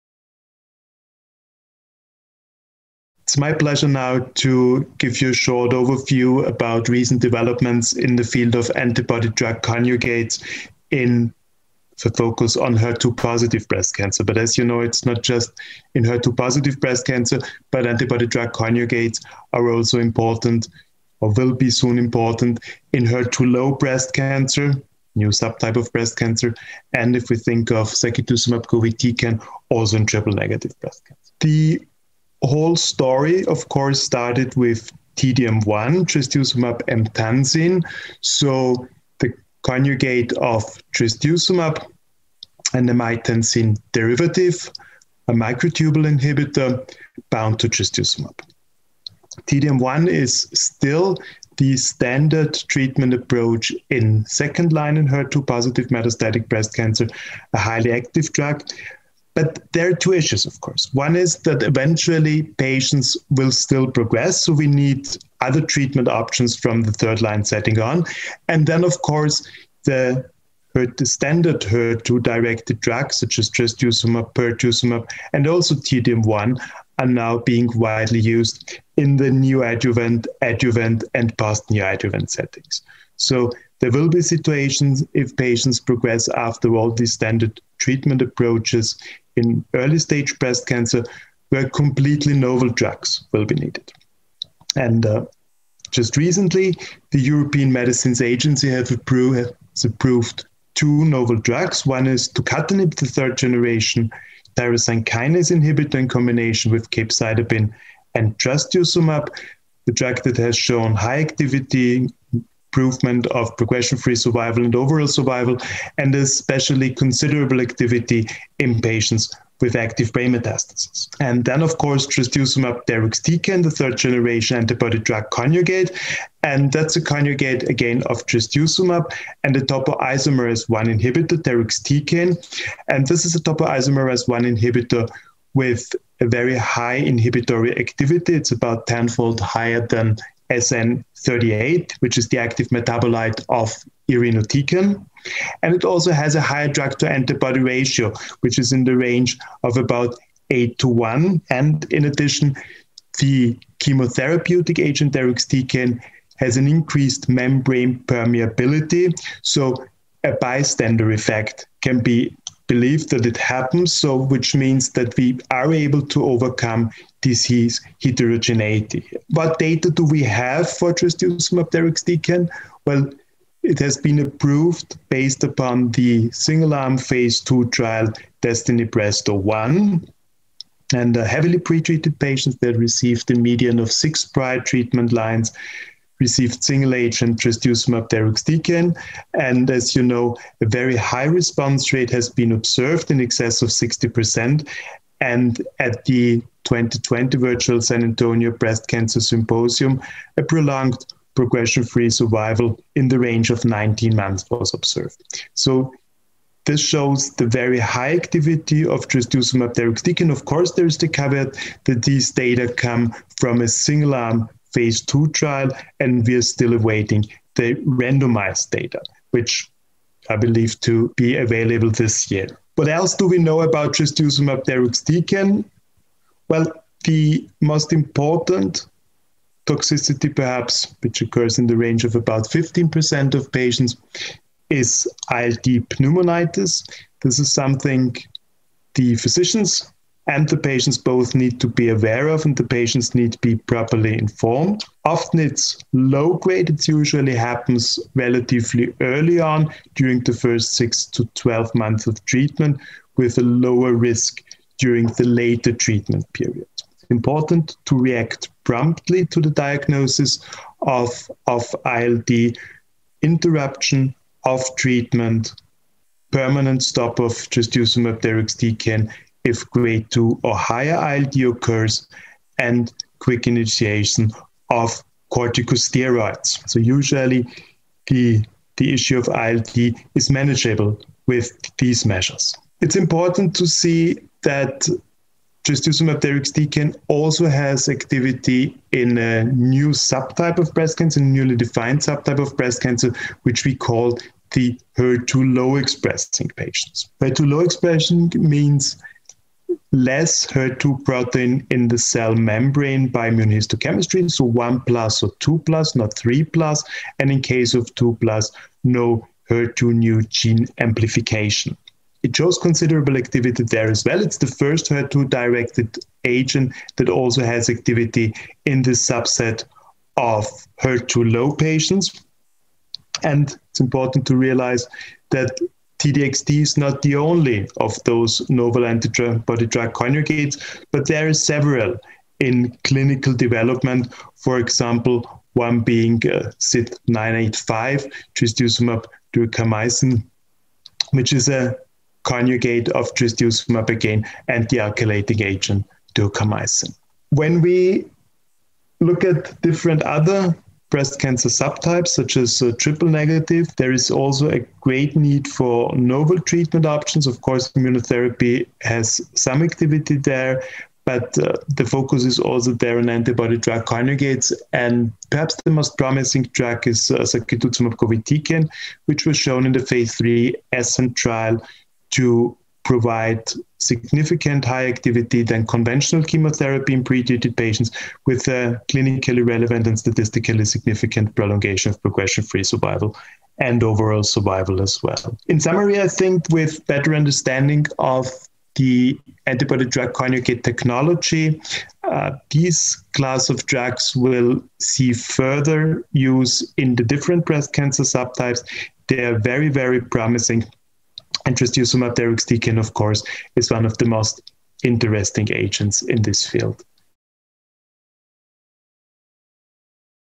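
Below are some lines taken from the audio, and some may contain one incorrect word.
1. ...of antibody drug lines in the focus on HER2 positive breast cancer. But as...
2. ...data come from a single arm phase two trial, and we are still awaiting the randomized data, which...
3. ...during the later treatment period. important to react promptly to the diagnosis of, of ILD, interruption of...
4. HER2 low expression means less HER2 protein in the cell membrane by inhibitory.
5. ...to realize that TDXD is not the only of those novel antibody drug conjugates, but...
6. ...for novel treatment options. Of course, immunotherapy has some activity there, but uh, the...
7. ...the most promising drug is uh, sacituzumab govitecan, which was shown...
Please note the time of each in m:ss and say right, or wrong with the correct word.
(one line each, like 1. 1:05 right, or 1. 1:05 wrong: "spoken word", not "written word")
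1. 0:08 wrong: "conjugates", not "lines"
2. 3:32 right
3. 4:14 right
4. 4:57 wrong: "immunohistochemistry", not "inhibitory"
5. 5:24 right
6. 5:55 right
7. 6:05 right.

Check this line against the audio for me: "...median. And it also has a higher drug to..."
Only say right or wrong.
wrong.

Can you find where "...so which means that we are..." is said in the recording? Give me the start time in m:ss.
2:43.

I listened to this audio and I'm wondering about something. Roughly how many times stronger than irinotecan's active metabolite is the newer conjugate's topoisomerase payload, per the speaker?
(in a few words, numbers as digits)
10-fold.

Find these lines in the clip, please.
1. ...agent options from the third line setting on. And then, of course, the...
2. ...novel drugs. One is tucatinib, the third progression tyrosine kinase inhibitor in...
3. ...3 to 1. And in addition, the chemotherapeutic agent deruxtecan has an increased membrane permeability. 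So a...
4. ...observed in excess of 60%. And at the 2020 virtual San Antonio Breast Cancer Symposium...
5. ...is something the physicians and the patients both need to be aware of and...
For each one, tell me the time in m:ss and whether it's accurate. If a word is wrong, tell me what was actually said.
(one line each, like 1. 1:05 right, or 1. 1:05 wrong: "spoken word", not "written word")
1. 1:05 wrong: "treatment", not "agent"
2. 1:41 wrong: "generation", not "progression"
3. 2:30 wrong: "8", not "3"
4. 3:12 right
5. 3:57 right.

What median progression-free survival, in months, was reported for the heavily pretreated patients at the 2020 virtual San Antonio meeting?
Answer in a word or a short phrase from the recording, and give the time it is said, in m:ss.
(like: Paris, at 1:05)
19 months, at 3:23.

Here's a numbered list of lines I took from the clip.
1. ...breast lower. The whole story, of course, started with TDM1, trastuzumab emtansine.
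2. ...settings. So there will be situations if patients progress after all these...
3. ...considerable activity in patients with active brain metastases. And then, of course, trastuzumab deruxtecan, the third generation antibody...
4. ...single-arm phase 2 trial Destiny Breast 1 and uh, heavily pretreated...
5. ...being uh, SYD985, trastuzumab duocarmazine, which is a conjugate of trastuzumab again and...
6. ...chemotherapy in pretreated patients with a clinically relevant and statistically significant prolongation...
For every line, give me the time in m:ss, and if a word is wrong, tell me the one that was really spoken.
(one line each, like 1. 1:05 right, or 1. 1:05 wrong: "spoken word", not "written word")
1. 0:30 wrong: "cancer", not "lower"
2. 1:22 right
3. 1:56 right
4. 2:56 right
5. 5:35 right
6. 6:16 right.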